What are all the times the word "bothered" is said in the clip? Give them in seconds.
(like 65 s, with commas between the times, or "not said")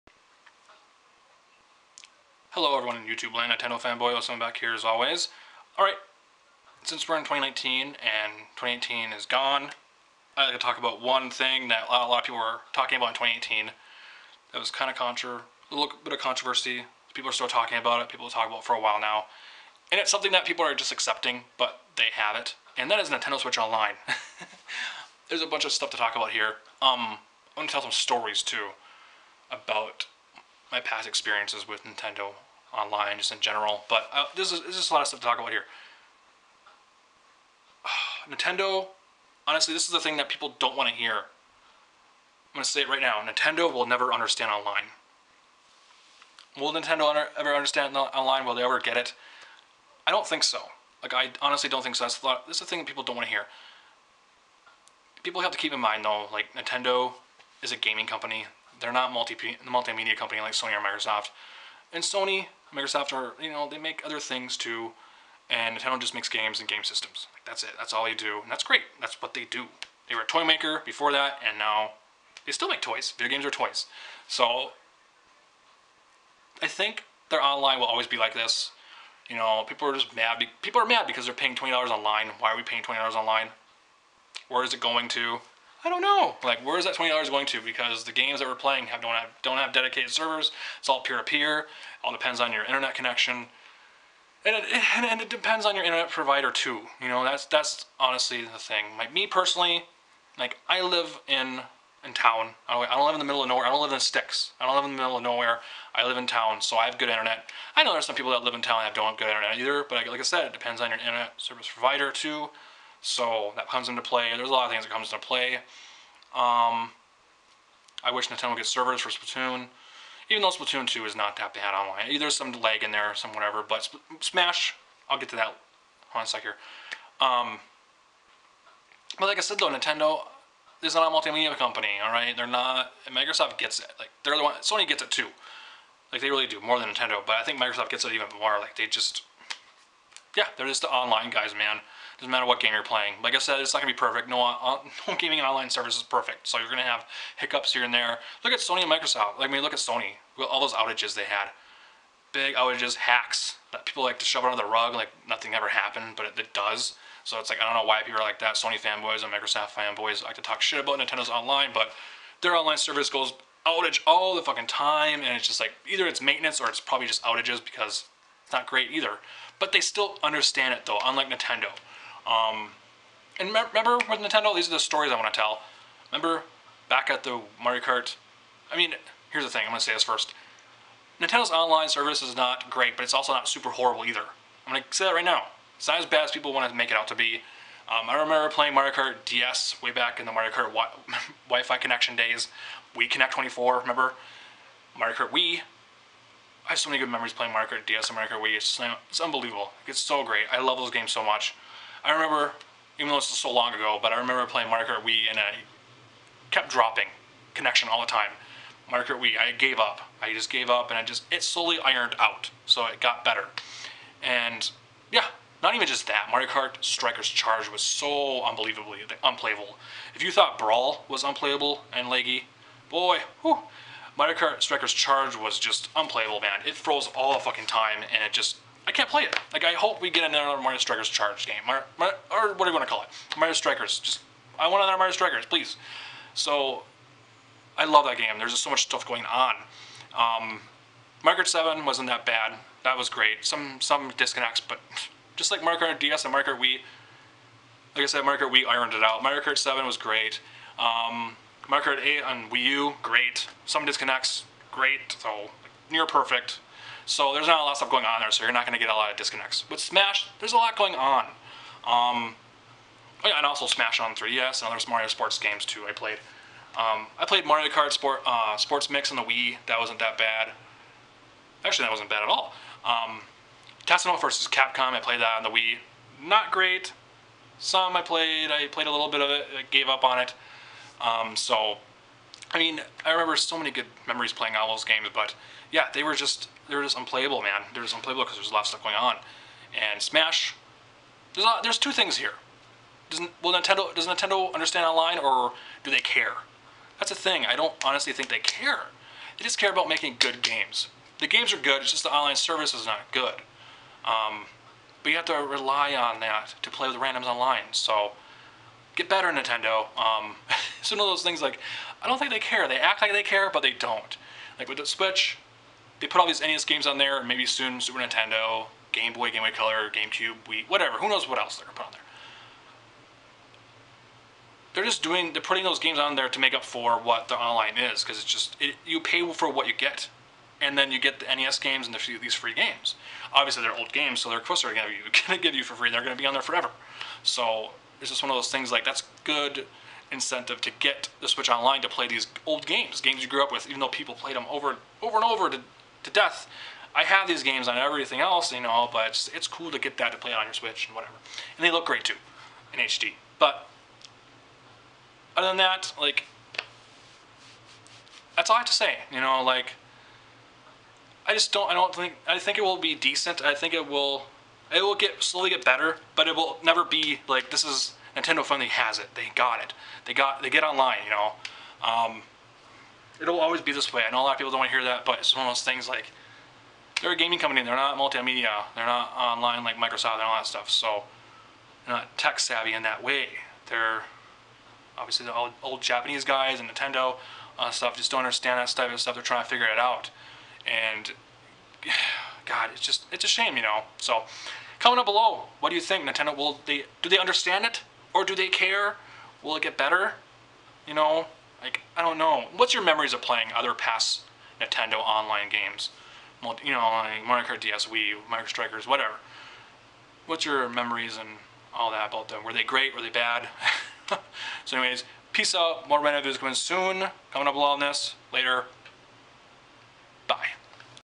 not said.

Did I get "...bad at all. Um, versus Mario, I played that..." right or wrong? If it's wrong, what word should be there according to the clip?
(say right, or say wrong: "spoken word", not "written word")
wrong: "Capcom", not "Mario".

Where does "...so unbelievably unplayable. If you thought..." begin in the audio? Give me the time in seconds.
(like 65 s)
217 s.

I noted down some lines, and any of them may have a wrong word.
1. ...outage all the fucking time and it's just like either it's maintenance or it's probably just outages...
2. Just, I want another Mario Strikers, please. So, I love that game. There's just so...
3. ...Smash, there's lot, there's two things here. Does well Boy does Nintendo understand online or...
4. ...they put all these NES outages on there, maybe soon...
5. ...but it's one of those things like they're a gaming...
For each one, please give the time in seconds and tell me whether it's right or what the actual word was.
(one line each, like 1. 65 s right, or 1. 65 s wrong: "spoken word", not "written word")
1. 163 s right
2. 233 s right
3. 290 s wrong: "Nintendo", not "Boy"
4. 315 s wrong: "games", not "outages"
5. 375 s right.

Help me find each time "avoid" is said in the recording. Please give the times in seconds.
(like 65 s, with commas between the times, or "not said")
not said.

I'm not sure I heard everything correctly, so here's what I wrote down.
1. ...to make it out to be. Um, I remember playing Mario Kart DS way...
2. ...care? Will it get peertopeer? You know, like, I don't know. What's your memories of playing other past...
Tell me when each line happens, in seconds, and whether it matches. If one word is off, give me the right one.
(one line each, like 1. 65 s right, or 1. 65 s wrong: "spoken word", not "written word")
1. 186 s right
2. 398 s wrong: "better", not "peertopeer".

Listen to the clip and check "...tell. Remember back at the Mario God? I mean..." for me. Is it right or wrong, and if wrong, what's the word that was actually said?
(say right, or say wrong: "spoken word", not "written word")
wrong: "Kart", not "God".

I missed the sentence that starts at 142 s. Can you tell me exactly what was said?
Doesn't matter what game you're playing.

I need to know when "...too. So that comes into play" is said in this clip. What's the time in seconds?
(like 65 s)
112 s.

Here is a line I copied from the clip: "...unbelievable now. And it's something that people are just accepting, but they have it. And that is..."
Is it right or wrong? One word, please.
wrong.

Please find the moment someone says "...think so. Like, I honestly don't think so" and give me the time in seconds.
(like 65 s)
50 s.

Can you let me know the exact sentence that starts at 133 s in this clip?
Like, they're the one, Sony gets it too.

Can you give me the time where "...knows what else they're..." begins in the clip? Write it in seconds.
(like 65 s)
321 s.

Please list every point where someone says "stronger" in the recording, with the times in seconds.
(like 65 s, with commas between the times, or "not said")
not said.